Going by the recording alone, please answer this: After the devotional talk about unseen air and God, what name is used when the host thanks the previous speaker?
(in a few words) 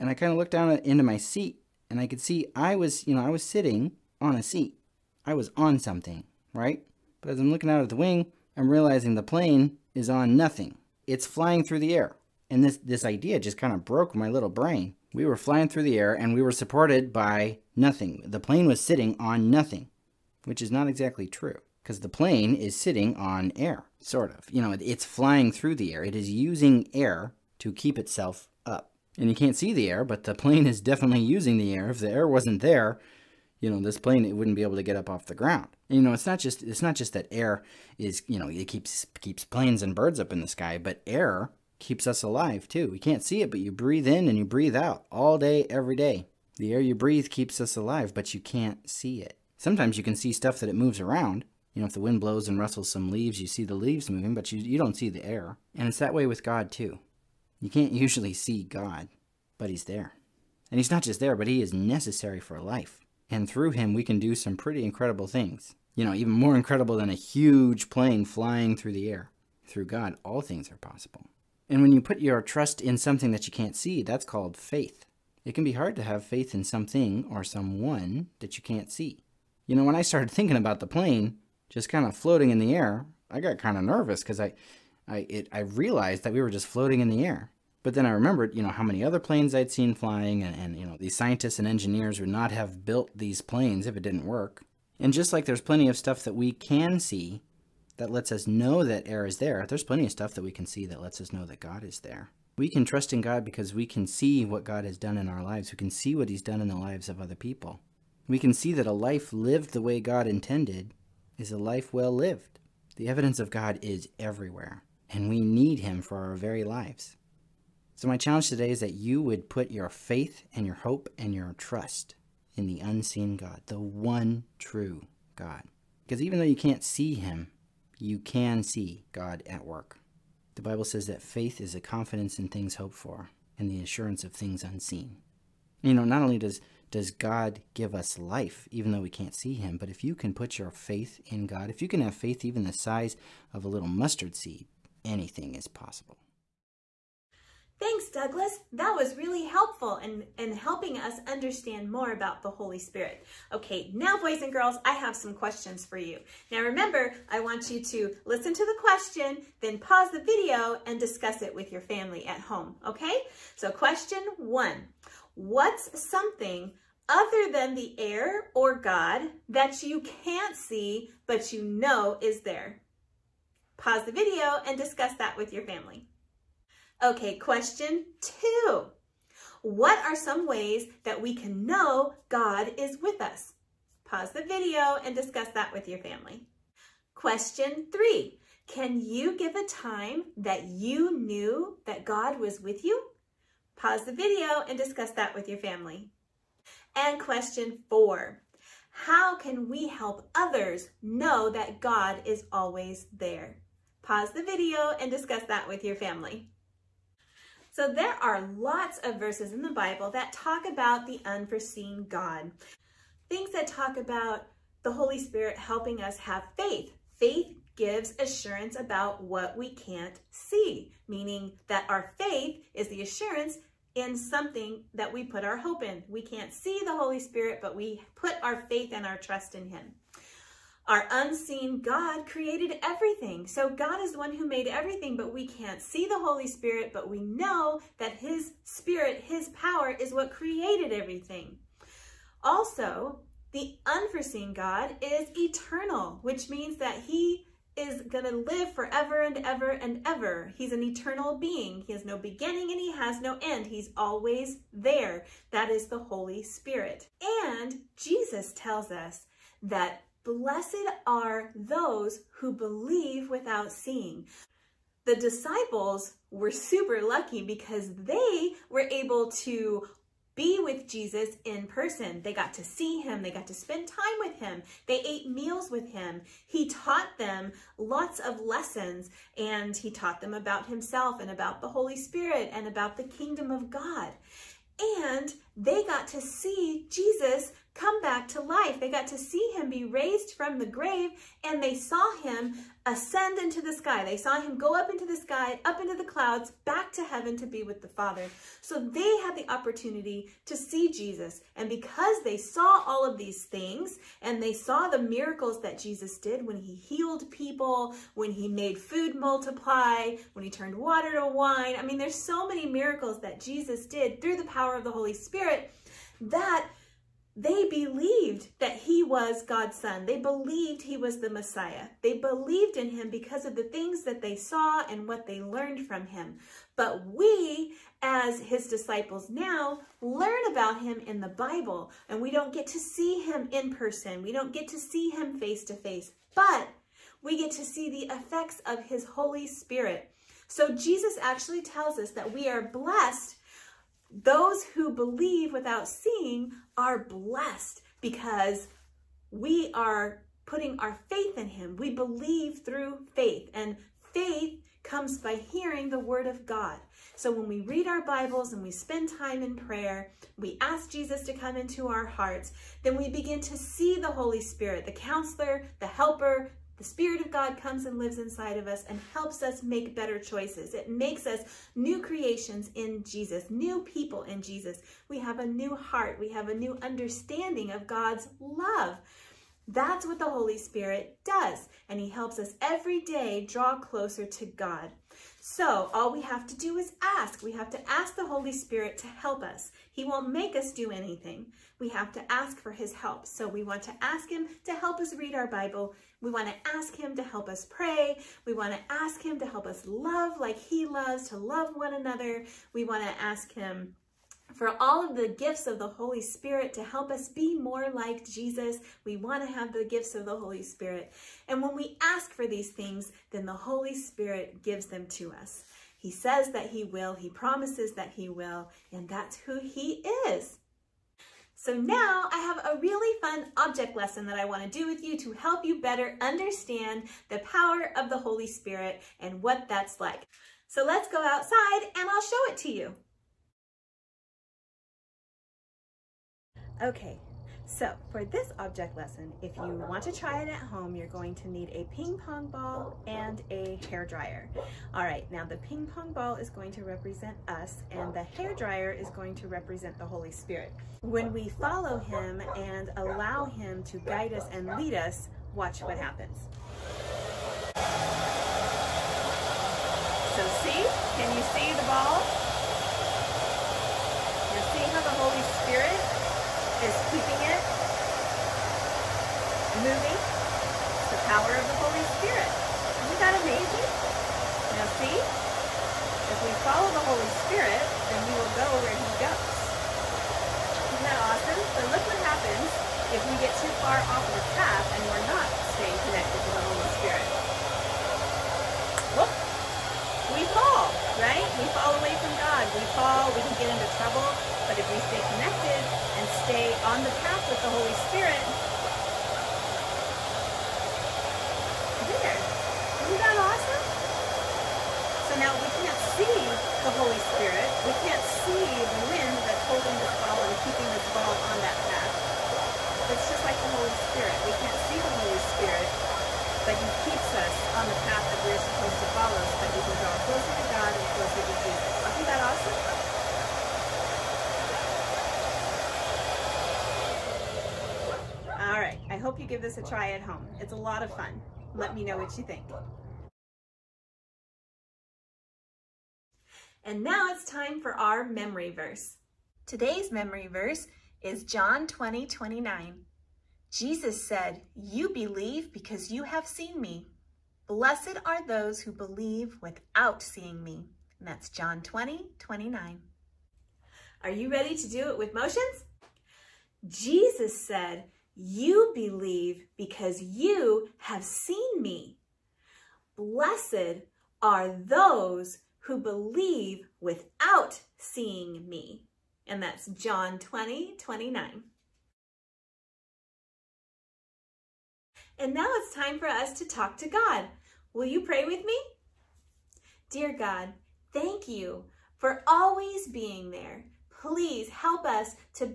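Douglas.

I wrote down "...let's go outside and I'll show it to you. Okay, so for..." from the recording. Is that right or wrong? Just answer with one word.
right.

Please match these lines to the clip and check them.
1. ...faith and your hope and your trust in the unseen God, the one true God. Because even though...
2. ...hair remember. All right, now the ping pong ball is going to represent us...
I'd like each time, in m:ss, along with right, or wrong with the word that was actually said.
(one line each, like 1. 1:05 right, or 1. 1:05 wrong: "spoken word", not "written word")
1. 1:59 right
2. 7:23 wrong: "dryer", not "remember".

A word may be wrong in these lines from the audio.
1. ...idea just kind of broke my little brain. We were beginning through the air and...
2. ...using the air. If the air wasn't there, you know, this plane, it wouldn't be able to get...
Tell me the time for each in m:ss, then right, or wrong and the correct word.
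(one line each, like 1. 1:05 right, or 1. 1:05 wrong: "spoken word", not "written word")
1. 0:13 wrong: "flying", not "beginning"
2. 0:31 right.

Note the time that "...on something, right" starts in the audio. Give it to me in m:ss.
0:05.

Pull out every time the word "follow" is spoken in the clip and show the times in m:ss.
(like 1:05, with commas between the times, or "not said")
7:31, 7:56, 8:39.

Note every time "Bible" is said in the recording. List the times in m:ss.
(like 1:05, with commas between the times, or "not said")
2:10, 3:29, 5:31, 5:58, 6:35.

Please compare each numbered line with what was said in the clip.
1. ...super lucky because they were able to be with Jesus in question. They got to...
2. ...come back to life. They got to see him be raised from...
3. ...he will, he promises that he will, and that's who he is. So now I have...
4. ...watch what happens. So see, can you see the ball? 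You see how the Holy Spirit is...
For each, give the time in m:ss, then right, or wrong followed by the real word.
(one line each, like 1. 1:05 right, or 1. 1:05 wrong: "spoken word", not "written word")
1. 4:26 wrong: "person", not "question"
2. 4:47 right
3. 6:56 right
4. 7:35 right.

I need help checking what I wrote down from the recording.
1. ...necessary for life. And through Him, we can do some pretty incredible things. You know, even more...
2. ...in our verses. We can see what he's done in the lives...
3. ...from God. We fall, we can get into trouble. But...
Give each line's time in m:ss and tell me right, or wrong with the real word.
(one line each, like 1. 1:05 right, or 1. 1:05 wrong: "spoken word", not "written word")
1. 1:01 right
2. 1:45 wrong: "lives", not "verses"
3. 8:12 right.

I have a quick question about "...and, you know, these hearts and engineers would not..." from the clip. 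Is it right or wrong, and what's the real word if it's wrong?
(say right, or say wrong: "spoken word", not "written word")
wrong: "scientists", not "hearts".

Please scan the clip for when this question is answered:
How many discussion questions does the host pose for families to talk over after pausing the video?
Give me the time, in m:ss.
3:17.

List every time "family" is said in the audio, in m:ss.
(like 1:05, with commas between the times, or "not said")
2:41, 2:55, 3:05, 3:15, 3:25.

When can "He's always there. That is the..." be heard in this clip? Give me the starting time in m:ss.
4:13.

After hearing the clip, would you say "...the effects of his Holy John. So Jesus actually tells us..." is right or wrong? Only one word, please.
wrong.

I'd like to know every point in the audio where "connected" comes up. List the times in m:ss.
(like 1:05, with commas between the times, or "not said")
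8:06, 8:15.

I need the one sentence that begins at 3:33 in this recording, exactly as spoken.
Things that talk about the Holy Spirit helping us have faith.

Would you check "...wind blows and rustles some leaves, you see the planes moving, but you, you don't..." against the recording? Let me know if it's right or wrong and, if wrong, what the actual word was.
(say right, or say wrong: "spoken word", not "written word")
wrong: "leaves", not "planes".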